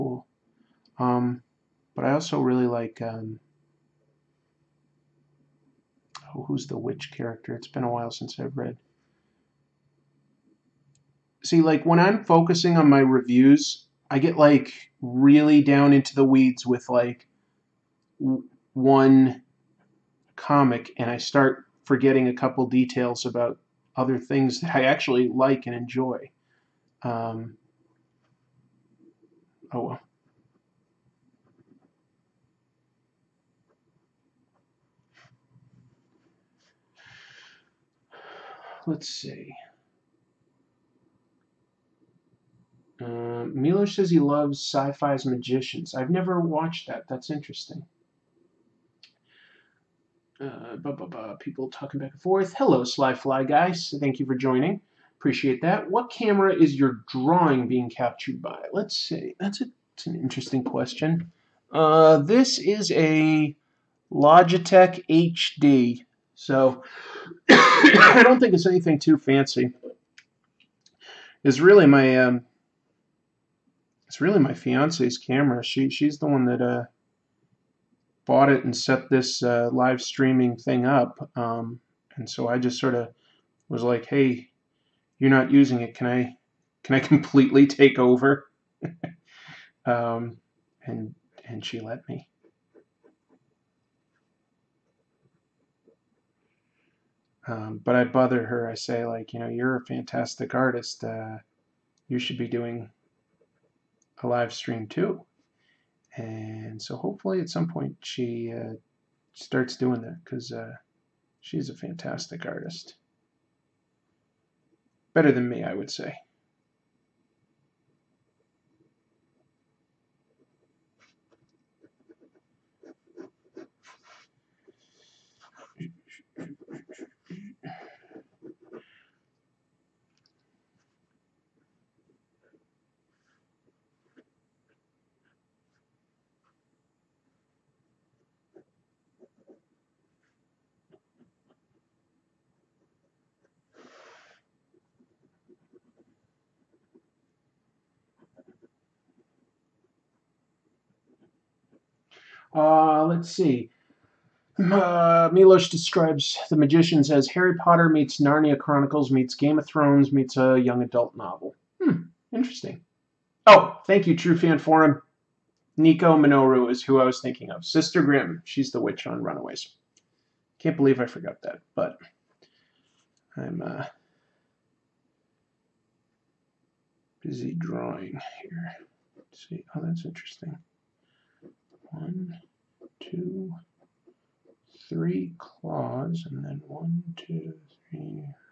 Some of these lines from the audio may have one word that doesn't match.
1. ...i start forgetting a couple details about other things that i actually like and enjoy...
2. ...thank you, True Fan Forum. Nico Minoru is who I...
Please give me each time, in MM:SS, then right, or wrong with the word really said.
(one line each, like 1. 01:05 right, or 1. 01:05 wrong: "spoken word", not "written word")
1. 00:21 right
2. 02:43 right.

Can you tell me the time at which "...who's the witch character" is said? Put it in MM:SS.
00:06.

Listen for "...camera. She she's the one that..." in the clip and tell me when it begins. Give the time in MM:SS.
01:15.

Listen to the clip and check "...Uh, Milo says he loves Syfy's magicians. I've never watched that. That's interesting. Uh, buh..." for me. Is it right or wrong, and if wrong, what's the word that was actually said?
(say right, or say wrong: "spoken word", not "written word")
right.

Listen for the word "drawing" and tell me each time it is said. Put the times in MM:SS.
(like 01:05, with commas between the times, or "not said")
00:57, 02:57.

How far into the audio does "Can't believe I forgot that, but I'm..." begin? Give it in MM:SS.
02:50.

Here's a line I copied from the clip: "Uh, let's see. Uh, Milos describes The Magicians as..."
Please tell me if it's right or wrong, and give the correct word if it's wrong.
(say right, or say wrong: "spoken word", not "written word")
right.